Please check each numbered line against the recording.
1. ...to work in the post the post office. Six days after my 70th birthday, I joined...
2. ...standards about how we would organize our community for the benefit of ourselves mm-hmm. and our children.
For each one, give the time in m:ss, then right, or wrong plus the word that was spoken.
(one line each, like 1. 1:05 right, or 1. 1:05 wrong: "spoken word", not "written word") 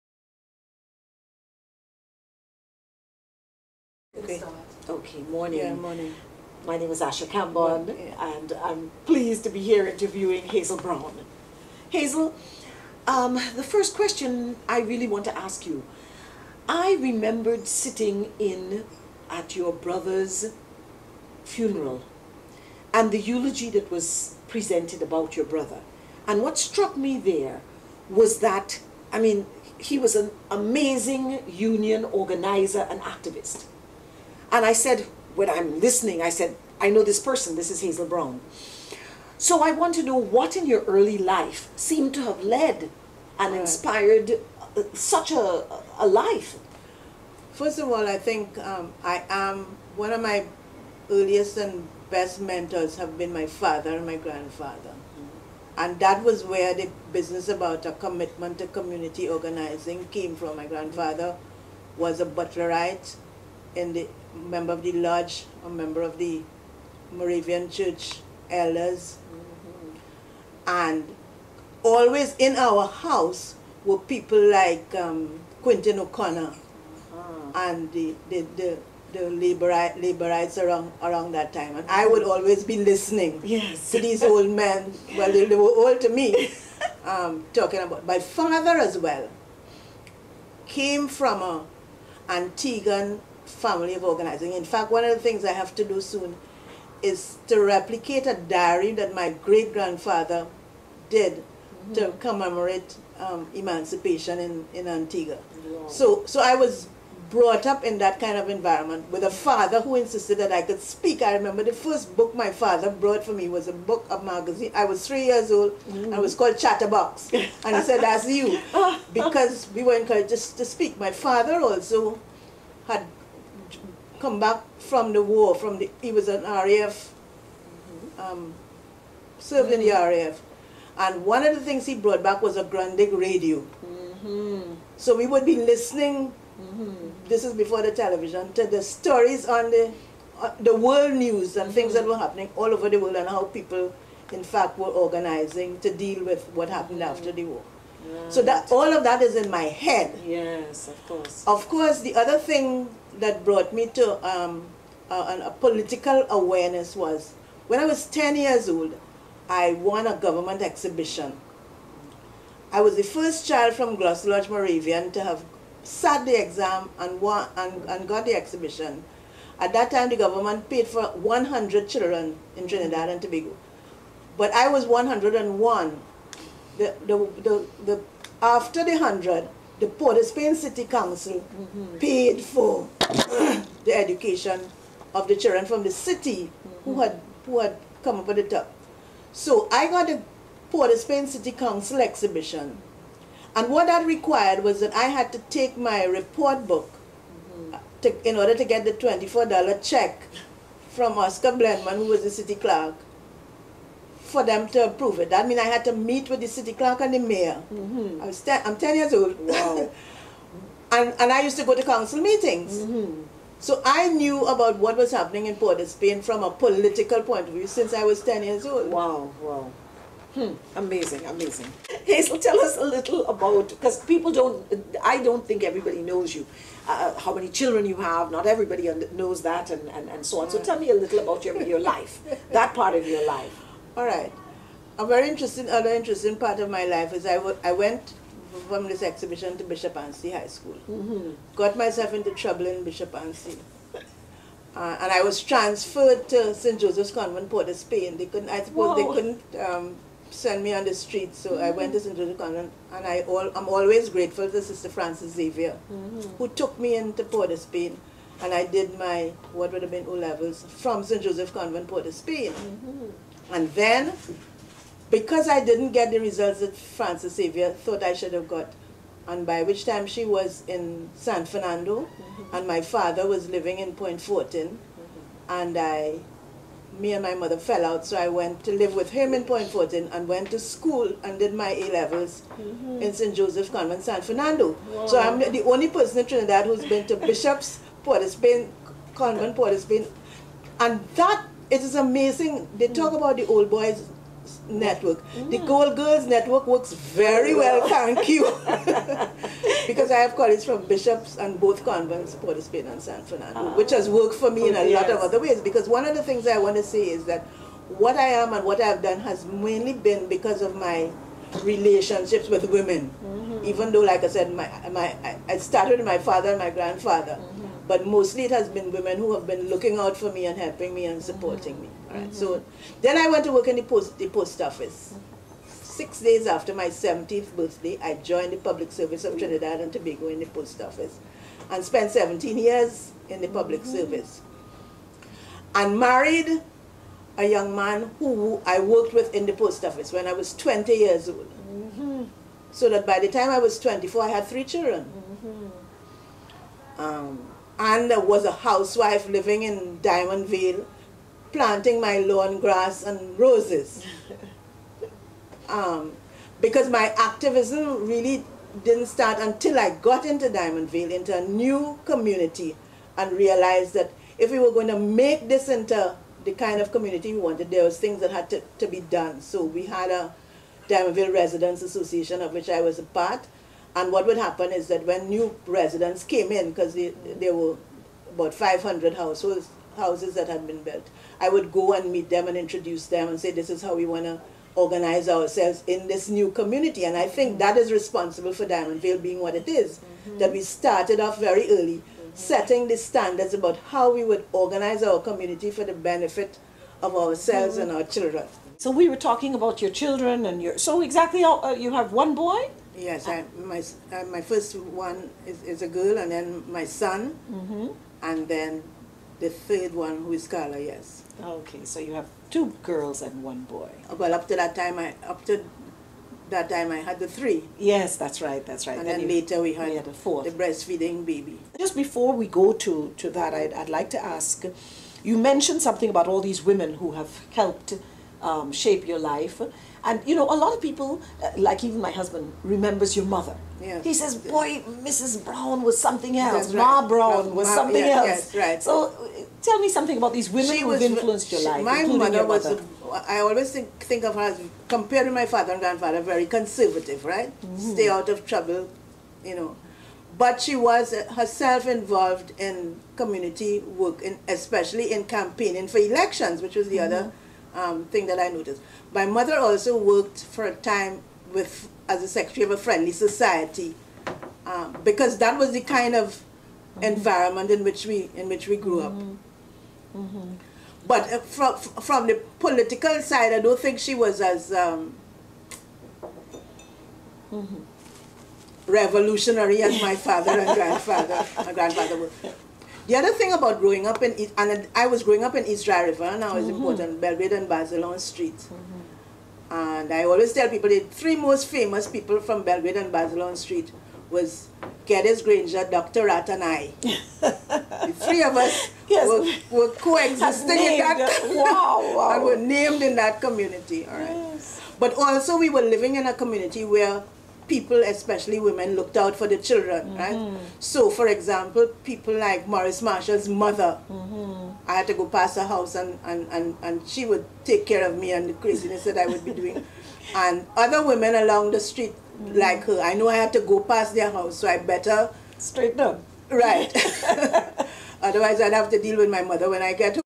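1. 5:23 right
2. 6:32 right.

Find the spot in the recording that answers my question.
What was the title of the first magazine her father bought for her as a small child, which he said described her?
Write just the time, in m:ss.
1:56.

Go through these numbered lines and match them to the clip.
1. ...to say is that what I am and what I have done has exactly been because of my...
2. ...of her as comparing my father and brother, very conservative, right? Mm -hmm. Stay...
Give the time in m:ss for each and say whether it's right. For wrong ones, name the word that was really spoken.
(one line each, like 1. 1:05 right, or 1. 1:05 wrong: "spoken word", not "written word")
1. 5:06 wrong: "mainly", not "exactly"
2. 7:24 wrong: "grandfather", not "brother".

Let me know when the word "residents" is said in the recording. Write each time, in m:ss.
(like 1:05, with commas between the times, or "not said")
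6:11, 6:15.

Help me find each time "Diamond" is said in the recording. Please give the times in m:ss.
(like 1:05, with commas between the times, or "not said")
5:50, 6:00, 6:10, 6:28.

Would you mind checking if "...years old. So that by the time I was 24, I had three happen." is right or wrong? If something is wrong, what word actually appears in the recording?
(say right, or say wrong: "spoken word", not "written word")
wrong: "children", not "happen".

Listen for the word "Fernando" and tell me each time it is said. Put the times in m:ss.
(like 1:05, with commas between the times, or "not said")
4:31, 4:44, 5:03.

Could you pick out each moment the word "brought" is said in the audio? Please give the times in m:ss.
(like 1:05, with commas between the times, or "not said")
1:47, 1:53, 2:11, 2:33.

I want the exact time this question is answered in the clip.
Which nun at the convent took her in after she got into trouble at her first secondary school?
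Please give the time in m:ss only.
4:14.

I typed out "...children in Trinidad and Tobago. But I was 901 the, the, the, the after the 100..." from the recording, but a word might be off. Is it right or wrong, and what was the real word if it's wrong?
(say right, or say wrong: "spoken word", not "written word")
wrong: "101", not "901".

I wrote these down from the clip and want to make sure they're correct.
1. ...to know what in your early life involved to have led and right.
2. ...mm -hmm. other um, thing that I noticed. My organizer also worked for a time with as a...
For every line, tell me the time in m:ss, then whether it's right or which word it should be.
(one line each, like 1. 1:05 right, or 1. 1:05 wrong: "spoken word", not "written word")
1. 0:39 wrong: "seemed", not "involved"
2. 7:36 wrong: "mother", not "organizer".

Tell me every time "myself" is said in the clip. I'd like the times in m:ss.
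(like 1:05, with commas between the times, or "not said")
4:01.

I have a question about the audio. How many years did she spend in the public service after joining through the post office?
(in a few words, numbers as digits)
17.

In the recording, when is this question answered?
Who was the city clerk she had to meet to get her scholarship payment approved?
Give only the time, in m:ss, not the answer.
3:21.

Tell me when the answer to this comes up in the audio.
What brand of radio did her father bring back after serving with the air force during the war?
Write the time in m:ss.
2:12.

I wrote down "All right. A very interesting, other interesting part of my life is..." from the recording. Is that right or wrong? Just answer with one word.
right.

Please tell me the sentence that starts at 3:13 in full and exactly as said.
And what that required was that I had to take my report book mm-hmm.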